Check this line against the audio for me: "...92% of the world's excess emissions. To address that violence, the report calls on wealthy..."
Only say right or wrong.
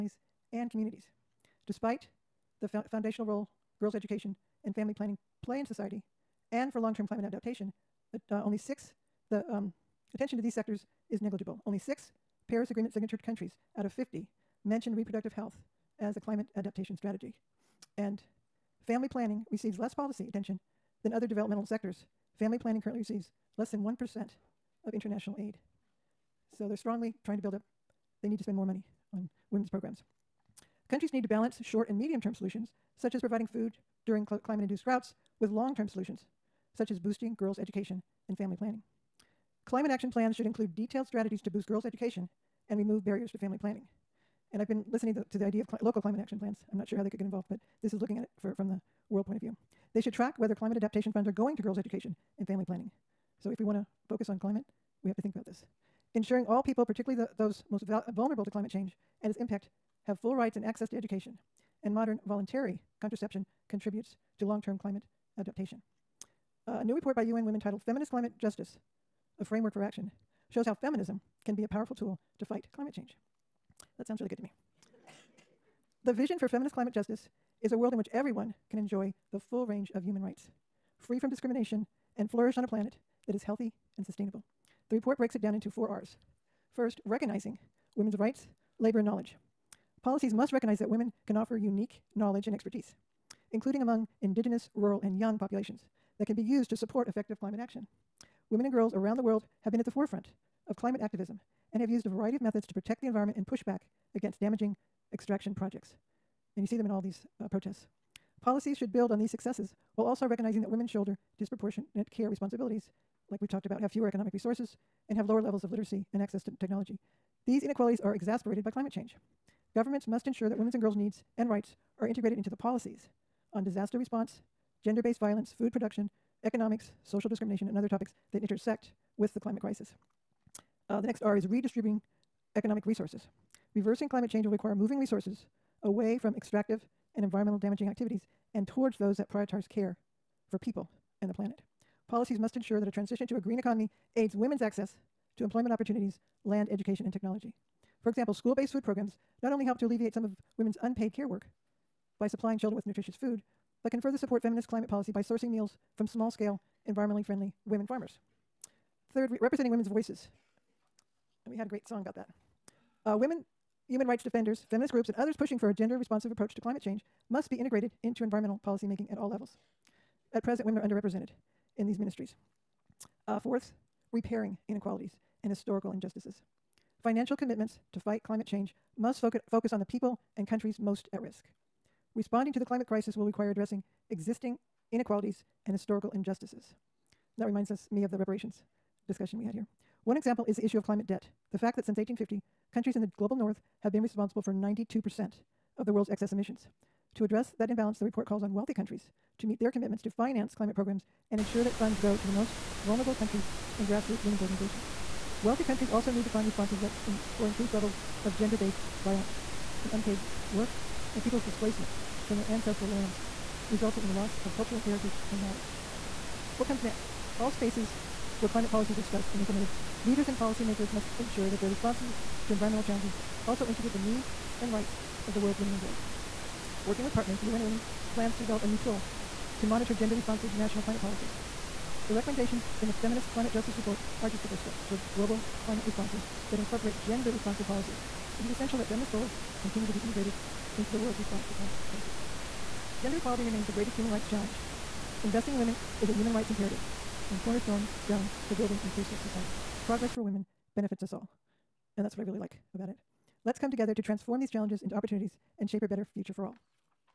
wrong.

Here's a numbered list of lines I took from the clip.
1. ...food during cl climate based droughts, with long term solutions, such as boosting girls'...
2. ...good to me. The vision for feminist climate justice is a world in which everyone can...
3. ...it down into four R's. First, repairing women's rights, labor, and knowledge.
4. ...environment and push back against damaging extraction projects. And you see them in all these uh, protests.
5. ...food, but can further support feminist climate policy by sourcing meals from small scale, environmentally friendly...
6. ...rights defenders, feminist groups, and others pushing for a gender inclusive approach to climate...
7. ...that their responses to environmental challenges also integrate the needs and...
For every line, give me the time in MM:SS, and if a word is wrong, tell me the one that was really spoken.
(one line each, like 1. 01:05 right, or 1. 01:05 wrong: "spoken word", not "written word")
1. 00:33 wrong: "induced", not "based"
2. 01:14 right
3. 01:25 wrong: "recognizing", not "repairing"
4. 01:43 right
5. 02:33 right
6. 02:44 wrong: "responsive", not "inclusive"
7. 03:41 right.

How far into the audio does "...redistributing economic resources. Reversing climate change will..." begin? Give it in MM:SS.
02:11.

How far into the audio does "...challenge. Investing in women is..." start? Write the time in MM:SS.
04:04.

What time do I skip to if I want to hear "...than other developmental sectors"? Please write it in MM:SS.
00:21.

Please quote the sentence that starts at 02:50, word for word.
At present, women are underrepresented in these ministries.